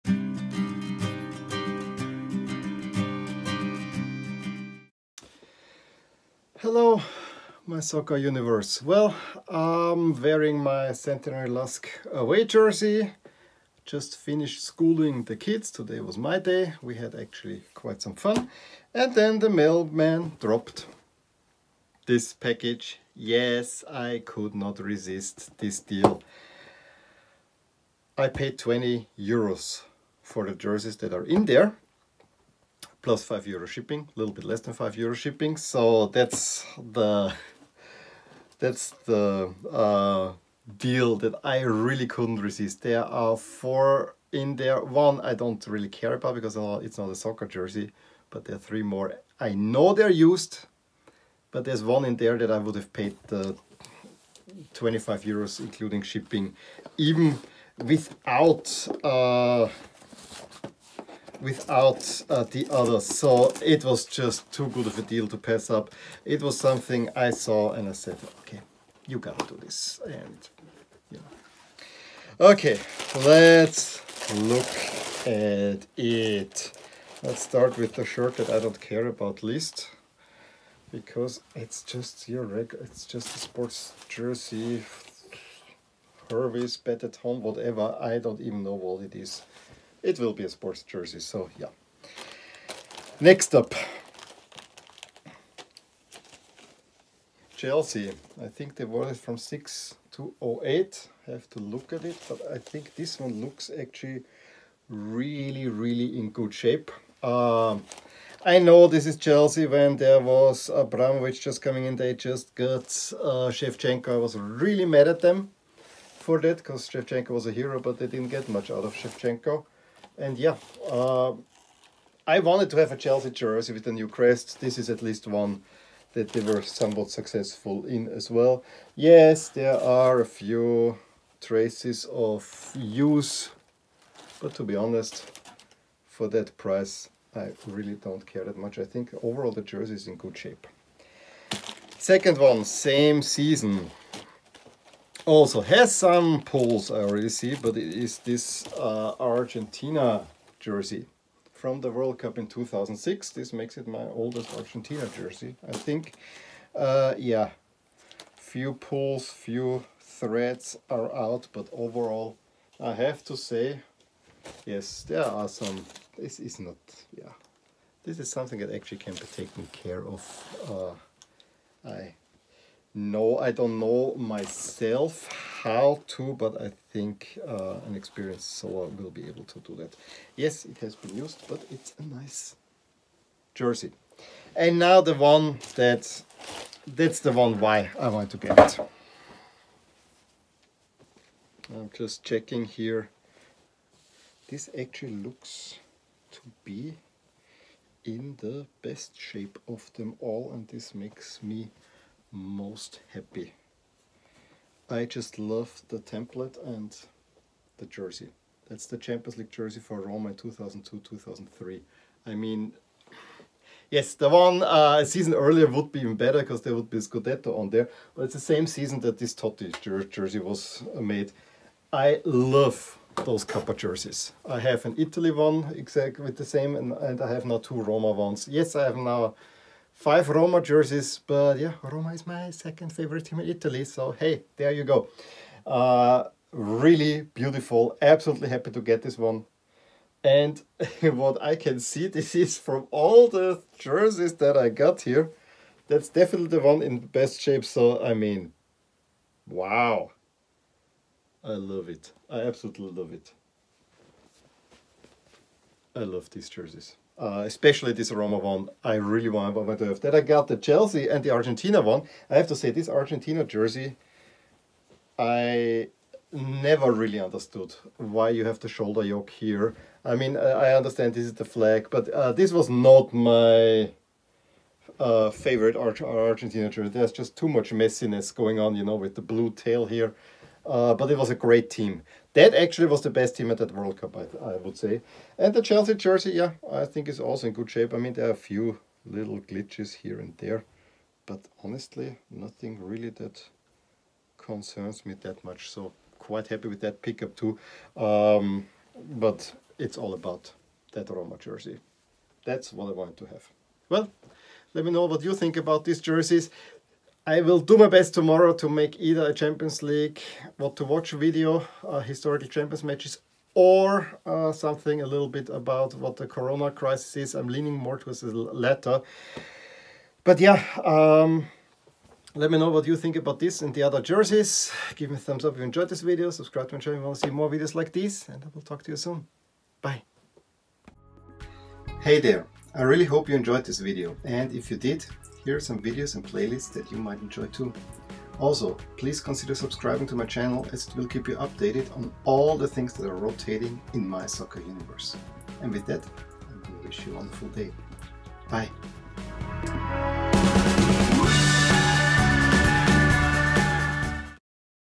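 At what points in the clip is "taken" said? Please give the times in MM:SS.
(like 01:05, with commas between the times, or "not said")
02:49.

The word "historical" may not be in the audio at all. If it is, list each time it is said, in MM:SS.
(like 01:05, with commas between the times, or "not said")
05:11.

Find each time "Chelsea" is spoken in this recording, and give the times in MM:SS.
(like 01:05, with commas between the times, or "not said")
01:37, 01:49, 02:02, 04:20, 04:45.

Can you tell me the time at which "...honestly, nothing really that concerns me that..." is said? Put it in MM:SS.
04:51.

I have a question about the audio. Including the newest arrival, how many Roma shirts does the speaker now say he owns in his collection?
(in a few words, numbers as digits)
5.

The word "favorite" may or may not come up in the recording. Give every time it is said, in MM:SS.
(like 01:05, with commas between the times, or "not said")
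03:52, 04:35.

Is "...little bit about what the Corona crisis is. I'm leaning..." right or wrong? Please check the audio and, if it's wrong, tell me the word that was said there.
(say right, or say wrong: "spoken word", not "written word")
right.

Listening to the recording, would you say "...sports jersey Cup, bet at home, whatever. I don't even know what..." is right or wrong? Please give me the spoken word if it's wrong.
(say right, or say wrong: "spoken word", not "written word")
wrong: "Hervis", not "Cup".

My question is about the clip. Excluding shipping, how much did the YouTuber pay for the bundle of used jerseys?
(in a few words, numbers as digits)
20 euros.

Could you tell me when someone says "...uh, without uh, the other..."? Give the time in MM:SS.
00:59.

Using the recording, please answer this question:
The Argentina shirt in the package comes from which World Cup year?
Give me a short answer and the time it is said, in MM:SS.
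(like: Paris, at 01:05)
2006, at 02:32.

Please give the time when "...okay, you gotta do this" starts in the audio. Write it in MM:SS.
01:08.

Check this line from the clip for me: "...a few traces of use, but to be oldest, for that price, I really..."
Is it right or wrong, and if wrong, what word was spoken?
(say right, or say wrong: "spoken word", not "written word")
wrong: "honest", not "oldest".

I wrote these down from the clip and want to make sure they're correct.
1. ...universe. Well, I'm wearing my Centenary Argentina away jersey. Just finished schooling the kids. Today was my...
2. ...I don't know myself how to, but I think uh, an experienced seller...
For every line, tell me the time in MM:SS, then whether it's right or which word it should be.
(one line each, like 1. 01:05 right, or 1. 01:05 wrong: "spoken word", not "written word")
1. 00:08 wrong: "Lusk", not "Argentina"
2. 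02:53 right.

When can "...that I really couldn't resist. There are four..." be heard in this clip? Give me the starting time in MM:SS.
00:41.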